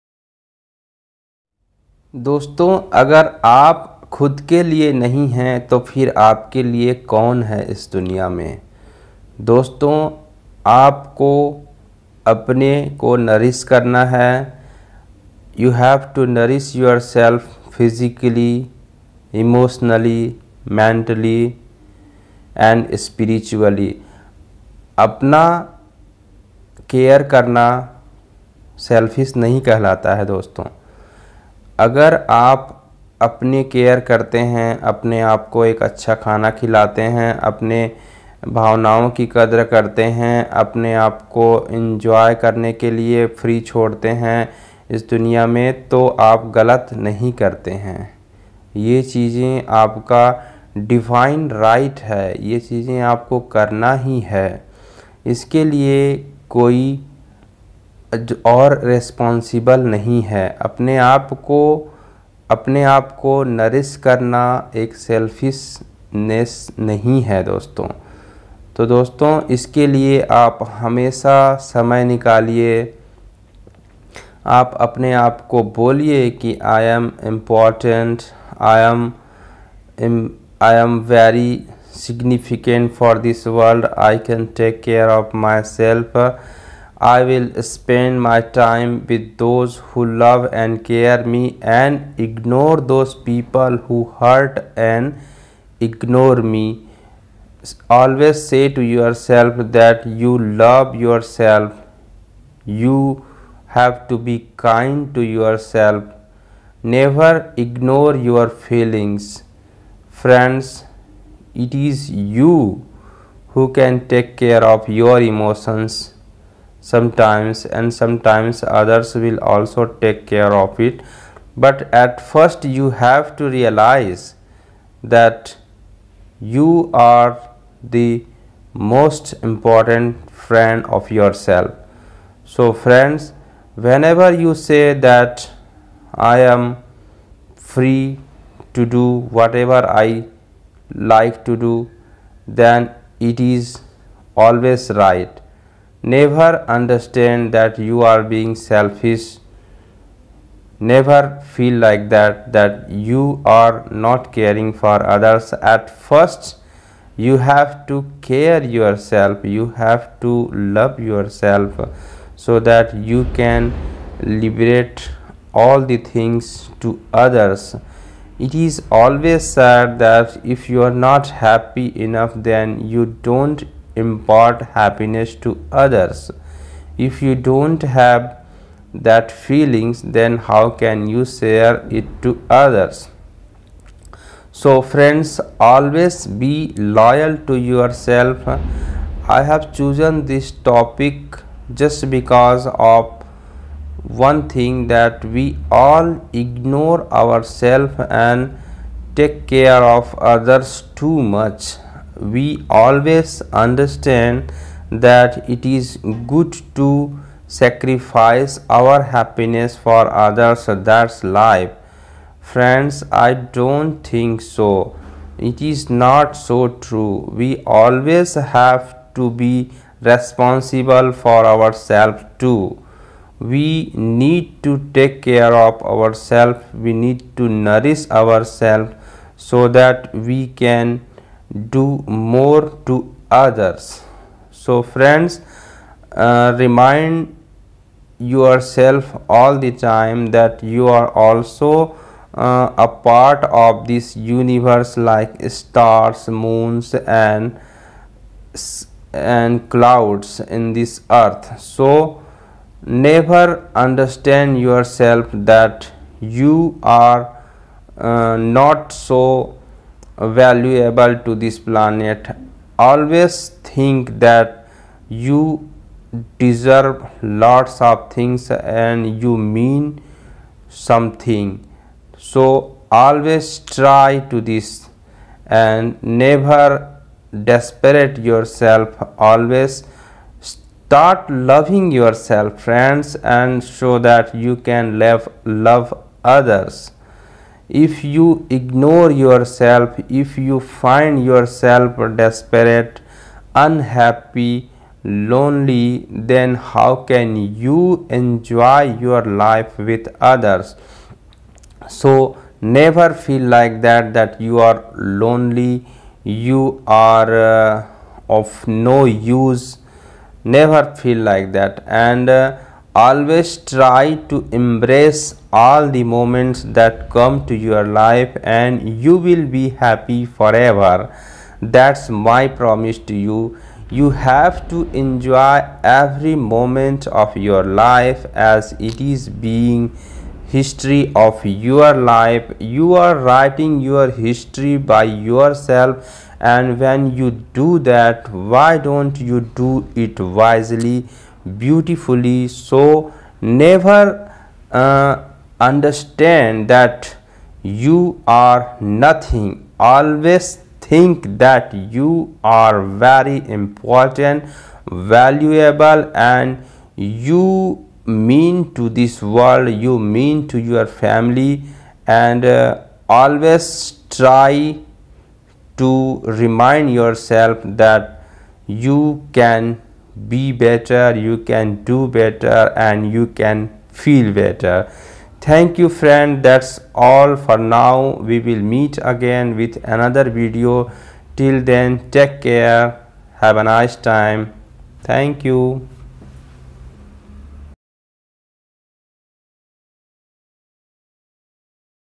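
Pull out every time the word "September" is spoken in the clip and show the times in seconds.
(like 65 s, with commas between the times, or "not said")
not said.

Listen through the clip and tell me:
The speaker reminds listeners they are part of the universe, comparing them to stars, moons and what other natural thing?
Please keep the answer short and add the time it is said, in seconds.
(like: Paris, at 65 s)
clouds, at 249 s.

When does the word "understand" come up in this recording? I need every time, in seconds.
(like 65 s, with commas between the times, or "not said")
146 s, 203 s, 253 s, 345 s.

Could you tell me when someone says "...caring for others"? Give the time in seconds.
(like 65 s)
154 s.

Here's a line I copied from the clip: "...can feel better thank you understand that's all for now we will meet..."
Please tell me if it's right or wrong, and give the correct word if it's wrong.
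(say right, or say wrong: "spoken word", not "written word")
wrong: "friend", not "understand".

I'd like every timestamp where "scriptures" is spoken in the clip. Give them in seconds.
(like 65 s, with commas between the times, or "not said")
not said.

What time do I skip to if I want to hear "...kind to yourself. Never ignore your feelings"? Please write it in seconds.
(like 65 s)
104 s.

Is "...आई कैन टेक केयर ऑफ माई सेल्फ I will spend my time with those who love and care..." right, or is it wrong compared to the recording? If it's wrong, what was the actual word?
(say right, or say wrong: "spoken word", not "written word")
right.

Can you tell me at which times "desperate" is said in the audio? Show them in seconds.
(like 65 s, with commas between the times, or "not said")
277 s, 292 s.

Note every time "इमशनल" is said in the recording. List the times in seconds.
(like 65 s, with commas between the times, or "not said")
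19 s.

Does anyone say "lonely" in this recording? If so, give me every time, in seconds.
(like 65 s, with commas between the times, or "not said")
295 s, 304 s.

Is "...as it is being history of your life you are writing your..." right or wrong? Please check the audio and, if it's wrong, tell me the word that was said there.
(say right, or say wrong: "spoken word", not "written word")
right.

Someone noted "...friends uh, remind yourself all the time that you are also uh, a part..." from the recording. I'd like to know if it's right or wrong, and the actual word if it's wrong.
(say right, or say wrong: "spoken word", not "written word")
right.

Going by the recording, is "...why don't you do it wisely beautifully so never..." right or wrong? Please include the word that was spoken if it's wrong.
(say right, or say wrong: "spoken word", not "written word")
right.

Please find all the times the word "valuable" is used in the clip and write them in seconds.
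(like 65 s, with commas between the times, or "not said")
260 s, 354 s.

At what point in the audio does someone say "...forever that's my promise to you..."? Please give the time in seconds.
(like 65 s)
320 s.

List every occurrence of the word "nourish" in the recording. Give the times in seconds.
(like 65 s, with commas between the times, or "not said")
227 s.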